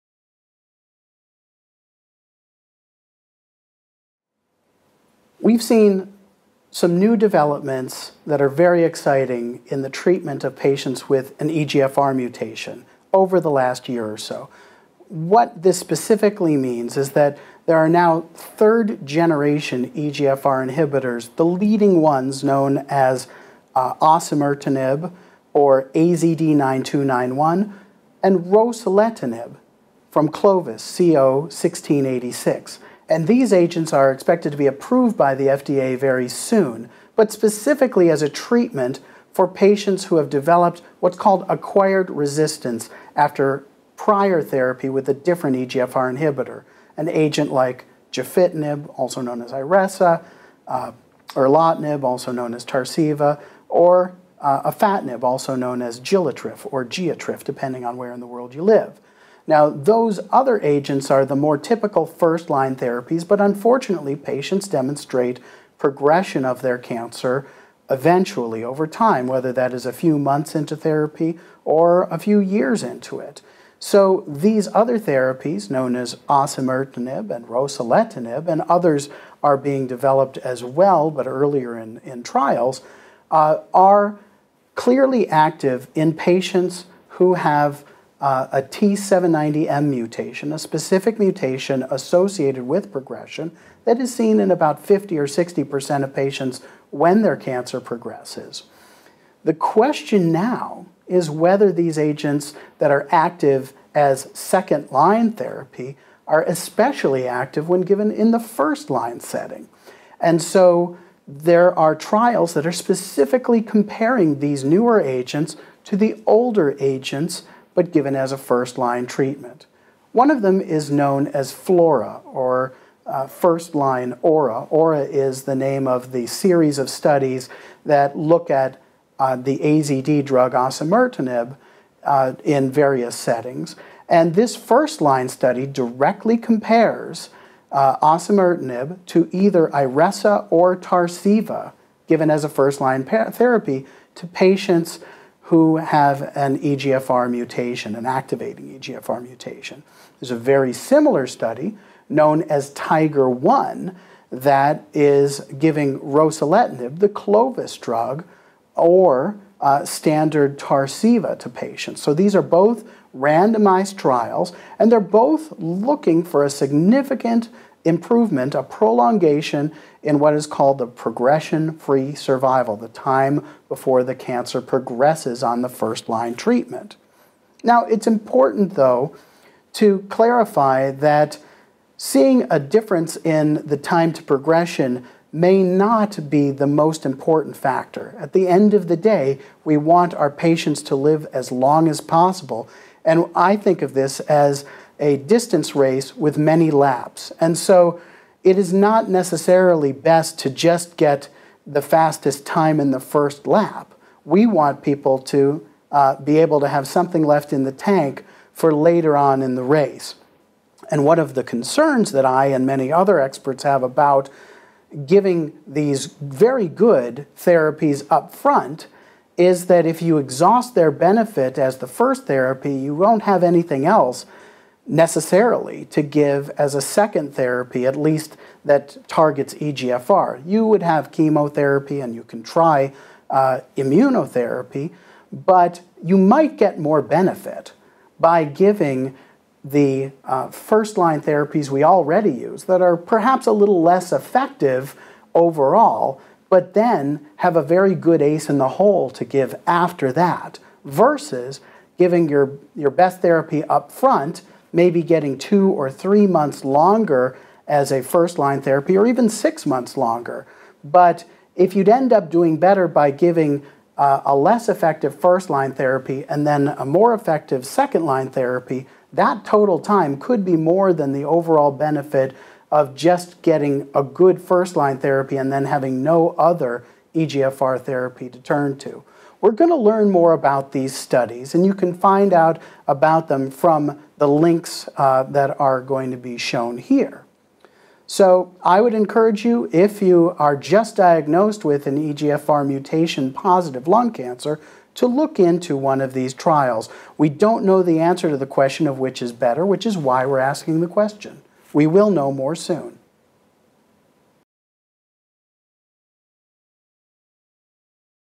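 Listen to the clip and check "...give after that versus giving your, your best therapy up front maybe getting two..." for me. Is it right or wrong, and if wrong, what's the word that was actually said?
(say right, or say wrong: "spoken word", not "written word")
right.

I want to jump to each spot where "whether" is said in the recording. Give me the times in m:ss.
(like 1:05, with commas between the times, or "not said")
1:09, 1:41.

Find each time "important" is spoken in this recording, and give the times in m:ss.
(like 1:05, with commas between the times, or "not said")
2:58, 3:07.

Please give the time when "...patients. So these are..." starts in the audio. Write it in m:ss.
2:41.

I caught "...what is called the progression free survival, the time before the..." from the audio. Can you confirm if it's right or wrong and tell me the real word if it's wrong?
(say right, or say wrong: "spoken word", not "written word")
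right.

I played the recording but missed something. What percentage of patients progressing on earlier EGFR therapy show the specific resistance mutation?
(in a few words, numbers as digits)
50 or 60%.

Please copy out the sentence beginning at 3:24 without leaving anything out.
We want people to uh, be able to have something left in the tank for later on in the race.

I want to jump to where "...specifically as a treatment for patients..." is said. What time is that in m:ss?
0:37.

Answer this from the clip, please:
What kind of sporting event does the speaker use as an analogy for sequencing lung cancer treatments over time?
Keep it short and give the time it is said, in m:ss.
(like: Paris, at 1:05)
distance race, at 3:15.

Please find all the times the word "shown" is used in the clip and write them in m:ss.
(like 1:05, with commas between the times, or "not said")
4:46.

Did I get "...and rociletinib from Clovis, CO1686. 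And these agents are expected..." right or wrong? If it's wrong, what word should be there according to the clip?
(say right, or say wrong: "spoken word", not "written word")
right.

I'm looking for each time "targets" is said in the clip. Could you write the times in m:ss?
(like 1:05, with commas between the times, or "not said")
3:49.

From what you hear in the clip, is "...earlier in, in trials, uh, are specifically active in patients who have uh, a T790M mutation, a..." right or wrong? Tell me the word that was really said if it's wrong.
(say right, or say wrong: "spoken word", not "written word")
wrong: "clearly", not "specifically".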